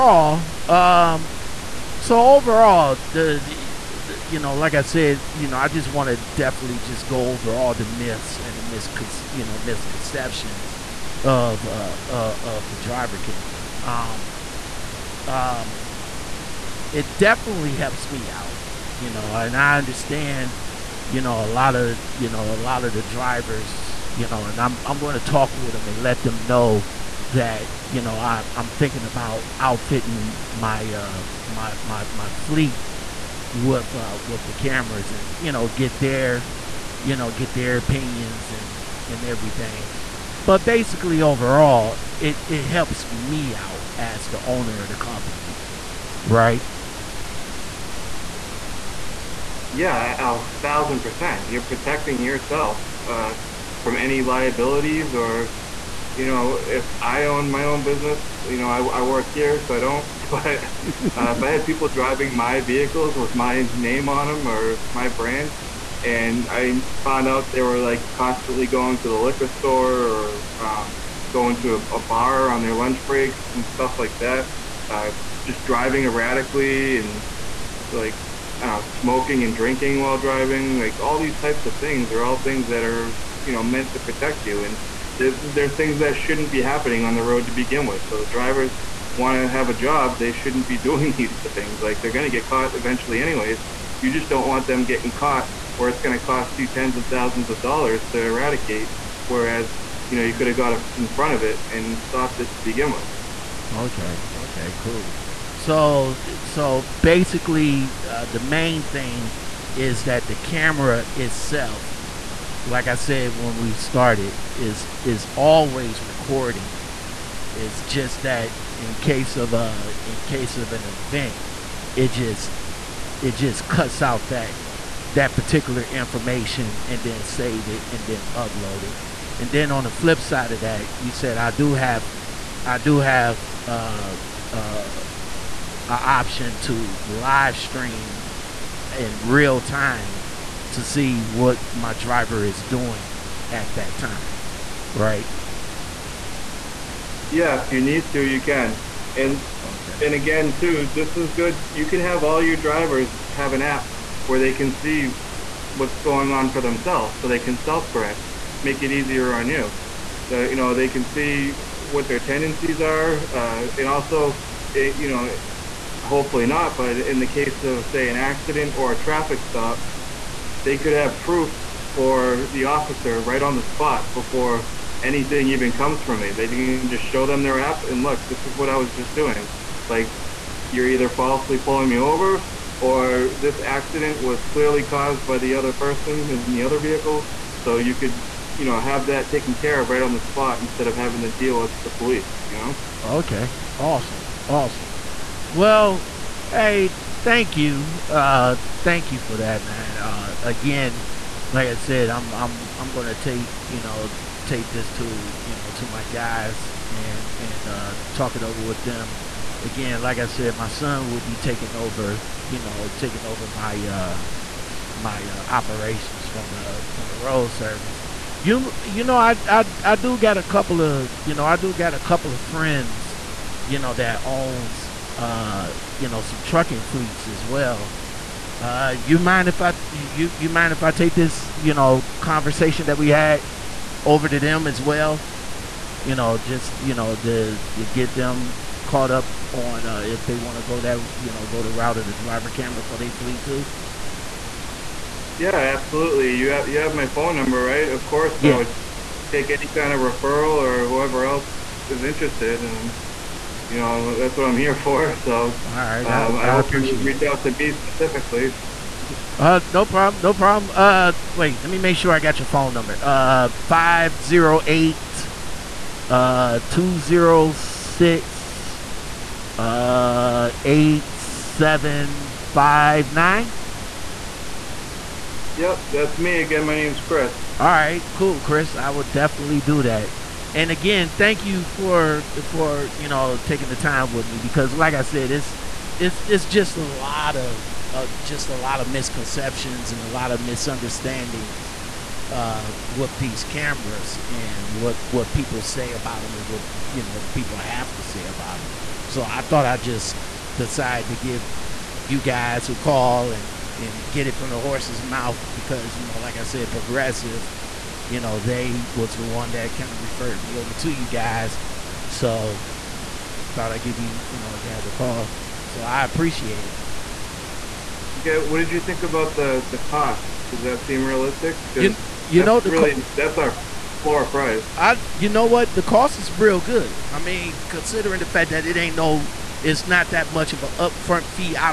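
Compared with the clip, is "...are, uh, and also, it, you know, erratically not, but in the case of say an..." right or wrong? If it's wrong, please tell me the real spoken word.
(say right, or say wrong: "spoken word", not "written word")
wrong: "hopefully", not "erratically".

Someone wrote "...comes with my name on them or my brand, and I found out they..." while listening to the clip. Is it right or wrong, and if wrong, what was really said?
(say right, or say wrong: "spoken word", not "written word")
wrong: "vehicles", not "comes".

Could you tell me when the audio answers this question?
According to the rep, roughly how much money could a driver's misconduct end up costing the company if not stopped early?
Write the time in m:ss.
1:36.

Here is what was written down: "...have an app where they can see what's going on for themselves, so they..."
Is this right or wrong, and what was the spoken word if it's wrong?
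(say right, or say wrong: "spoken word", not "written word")
right.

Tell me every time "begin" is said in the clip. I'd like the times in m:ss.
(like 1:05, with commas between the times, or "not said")
1:27, 1:42.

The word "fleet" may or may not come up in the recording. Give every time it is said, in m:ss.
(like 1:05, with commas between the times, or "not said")
0:32, 3:46, 4:03.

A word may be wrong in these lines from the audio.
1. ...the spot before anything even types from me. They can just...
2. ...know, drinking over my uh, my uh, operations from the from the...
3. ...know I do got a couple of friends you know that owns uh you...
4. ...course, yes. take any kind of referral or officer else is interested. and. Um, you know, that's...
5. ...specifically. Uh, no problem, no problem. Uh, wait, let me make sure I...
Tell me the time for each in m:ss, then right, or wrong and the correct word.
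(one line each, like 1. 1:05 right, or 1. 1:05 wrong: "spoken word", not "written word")
1. 2:53 wrong: "comes", not "types"
2. 3:32 wrong: "taking", not "drinking"
3. 3:41 right
4. 4:08 wrong: "whoever", not "officer"
5. 4:17 right.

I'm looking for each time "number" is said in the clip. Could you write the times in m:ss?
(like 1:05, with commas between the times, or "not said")
4:07, 4:22.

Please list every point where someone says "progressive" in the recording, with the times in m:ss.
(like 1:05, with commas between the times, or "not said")
5:06.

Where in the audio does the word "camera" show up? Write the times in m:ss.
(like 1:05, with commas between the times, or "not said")
0:13, 0:34, 1:50, 4:02, 4:53.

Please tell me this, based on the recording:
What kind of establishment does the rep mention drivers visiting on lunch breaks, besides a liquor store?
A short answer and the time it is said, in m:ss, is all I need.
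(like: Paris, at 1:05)
A bar, at 1:12.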